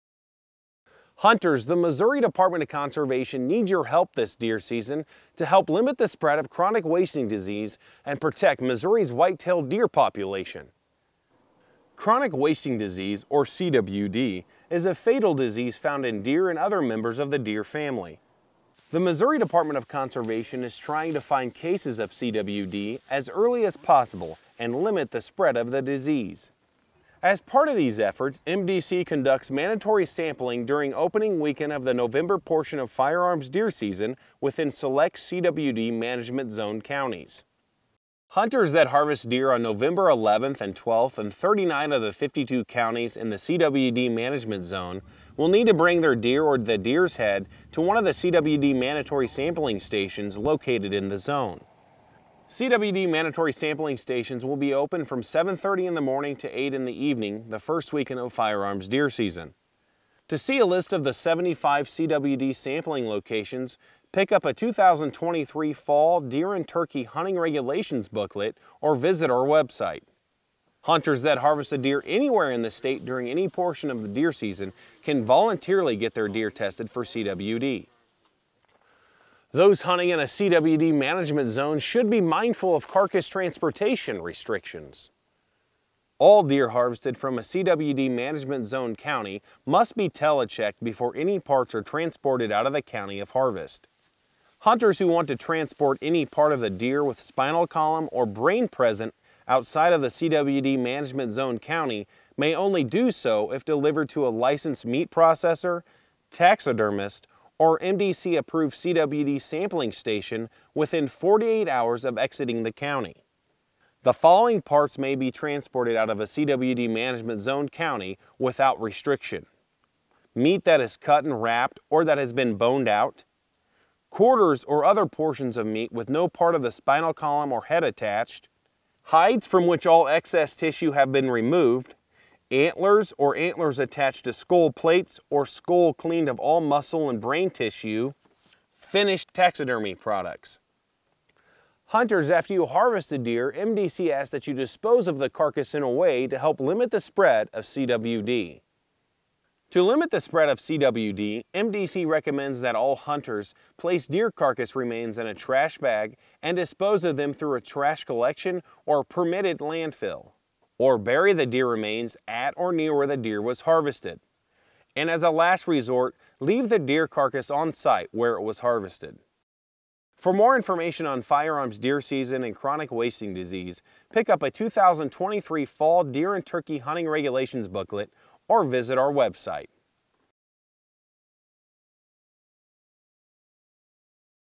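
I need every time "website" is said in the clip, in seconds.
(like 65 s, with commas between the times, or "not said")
69 s, 179 s.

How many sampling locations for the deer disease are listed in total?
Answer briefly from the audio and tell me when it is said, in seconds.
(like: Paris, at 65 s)
75, at 61 s.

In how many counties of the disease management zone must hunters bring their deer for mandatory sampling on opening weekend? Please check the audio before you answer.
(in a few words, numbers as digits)
39.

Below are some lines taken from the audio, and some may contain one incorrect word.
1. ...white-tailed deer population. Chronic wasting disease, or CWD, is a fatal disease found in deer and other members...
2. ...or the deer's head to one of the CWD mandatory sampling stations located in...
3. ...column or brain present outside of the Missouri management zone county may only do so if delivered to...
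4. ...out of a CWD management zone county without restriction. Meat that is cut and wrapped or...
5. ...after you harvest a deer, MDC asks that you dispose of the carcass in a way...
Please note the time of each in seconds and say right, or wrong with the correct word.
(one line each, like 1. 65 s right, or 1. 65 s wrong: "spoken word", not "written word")
1. 9 s right
2. 46 s right
3. 97 s wrong: "CWD", not "Missouri"
4. 115 s right
5. 142 s right.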